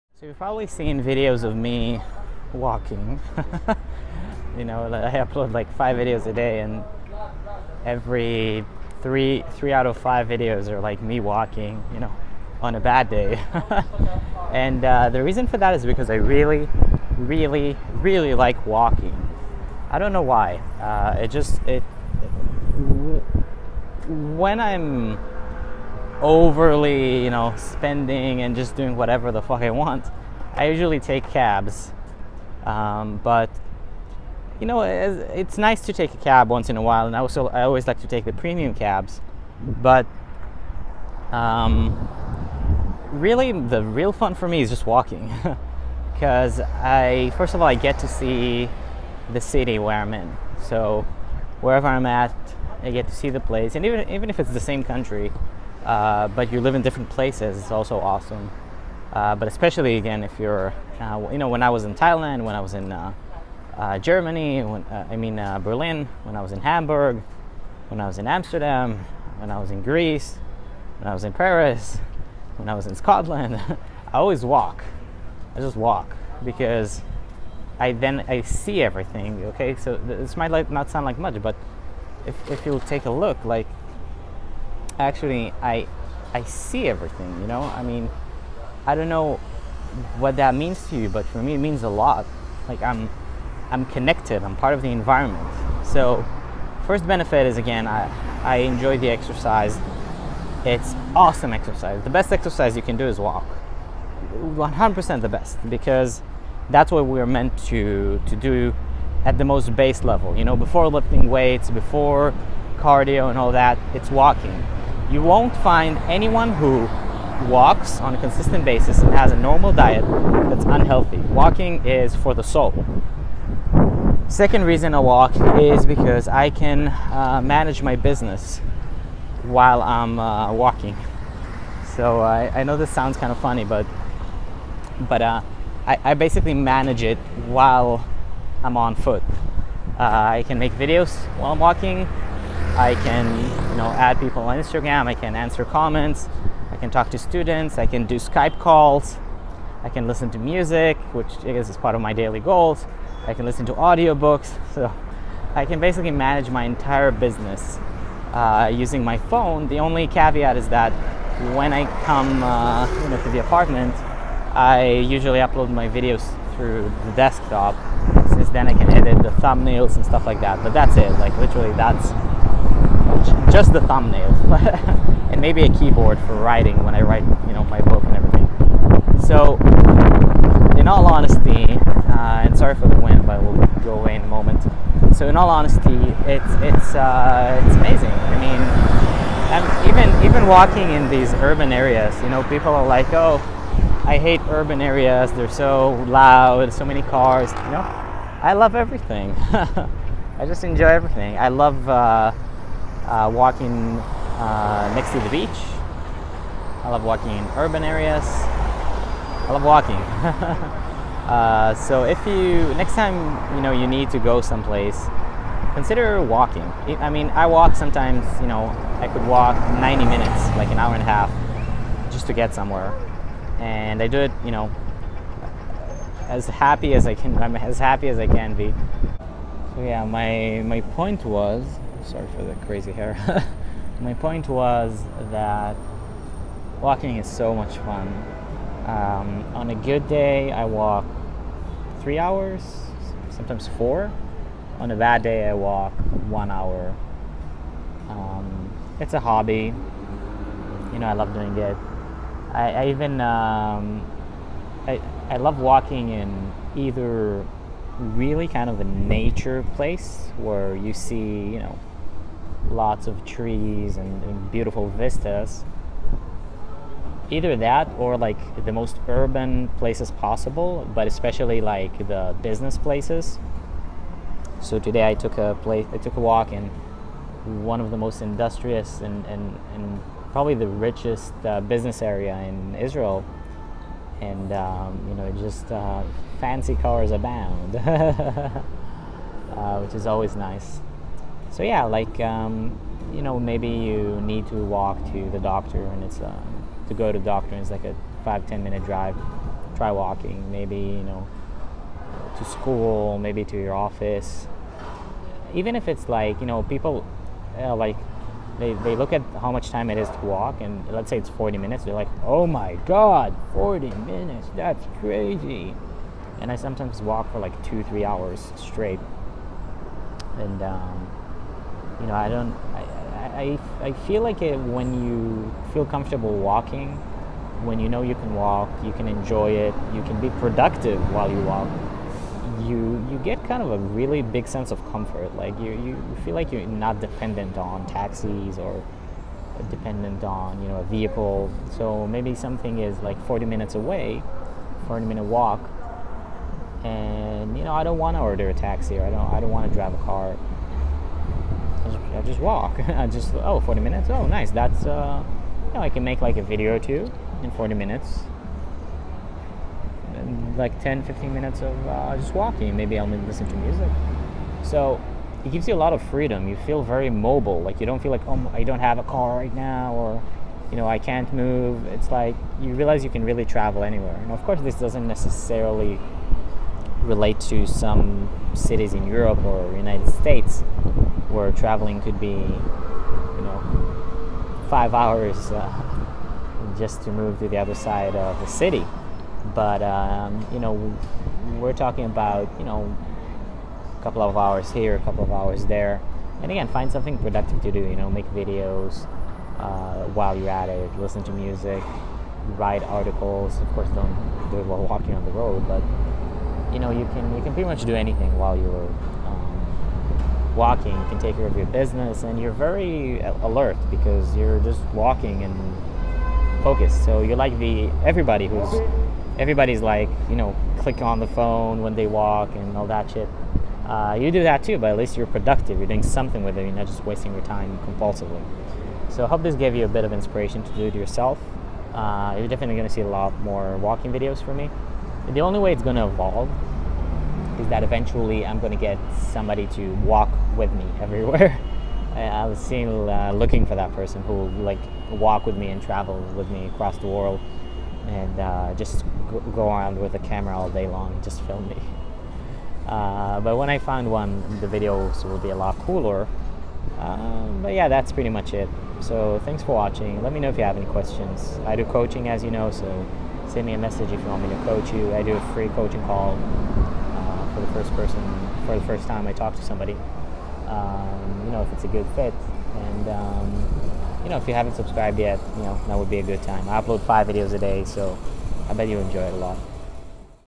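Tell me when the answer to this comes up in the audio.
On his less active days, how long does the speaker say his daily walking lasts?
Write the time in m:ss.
4:06.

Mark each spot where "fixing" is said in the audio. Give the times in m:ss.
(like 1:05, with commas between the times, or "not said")
not said.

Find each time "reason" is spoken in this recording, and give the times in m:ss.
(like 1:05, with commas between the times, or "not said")
0:15, 2:04.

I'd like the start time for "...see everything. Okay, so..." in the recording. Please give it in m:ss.
1:18.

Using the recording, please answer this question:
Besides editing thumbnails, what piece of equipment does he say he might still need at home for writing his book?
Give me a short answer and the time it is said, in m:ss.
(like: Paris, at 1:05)
a keyboard, at 2:55.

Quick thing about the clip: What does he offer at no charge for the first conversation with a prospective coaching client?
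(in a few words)
a free coaching call.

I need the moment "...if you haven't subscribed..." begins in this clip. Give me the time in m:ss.
7:54.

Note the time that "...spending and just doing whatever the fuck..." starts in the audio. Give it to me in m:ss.
0:27.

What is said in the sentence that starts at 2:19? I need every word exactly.
Uh, I can make videos while I'm walking.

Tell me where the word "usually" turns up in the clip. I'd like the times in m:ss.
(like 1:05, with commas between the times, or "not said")
0:30, 2:44.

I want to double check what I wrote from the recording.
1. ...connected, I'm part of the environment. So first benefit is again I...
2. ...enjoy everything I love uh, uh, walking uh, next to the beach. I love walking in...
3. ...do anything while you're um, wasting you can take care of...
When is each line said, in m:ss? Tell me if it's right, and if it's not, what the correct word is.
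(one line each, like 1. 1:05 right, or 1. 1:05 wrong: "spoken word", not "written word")
1. 1:33 right
2. 3:20 right
3. 6:47 wrong: "walking", not "wasting".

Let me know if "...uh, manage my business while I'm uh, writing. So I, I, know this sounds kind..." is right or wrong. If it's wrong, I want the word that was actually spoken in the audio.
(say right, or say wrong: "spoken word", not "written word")
wrong: "walking", not "writing".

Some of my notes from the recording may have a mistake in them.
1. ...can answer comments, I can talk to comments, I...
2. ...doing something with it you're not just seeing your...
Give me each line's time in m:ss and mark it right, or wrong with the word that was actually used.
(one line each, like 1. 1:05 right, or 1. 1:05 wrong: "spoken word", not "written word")
1. 2:25 wrong: "students", not "comments"
2. 7:05 wrong: "wasting", not "seeing".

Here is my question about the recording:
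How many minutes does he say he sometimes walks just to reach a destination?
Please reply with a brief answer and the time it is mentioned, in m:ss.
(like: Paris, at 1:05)
90, at 3:39.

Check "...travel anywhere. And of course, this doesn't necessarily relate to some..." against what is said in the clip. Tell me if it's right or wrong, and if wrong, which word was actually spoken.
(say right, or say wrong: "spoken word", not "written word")
right.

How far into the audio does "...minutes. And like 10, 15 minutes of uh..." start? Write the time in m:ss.
5:57.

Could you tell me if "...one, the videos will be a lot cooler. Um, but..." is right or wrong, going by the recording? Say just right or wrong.
right.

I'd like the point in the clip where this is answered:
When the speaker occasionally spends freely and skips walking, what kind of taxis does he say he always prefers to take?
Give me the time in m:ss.
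0:38.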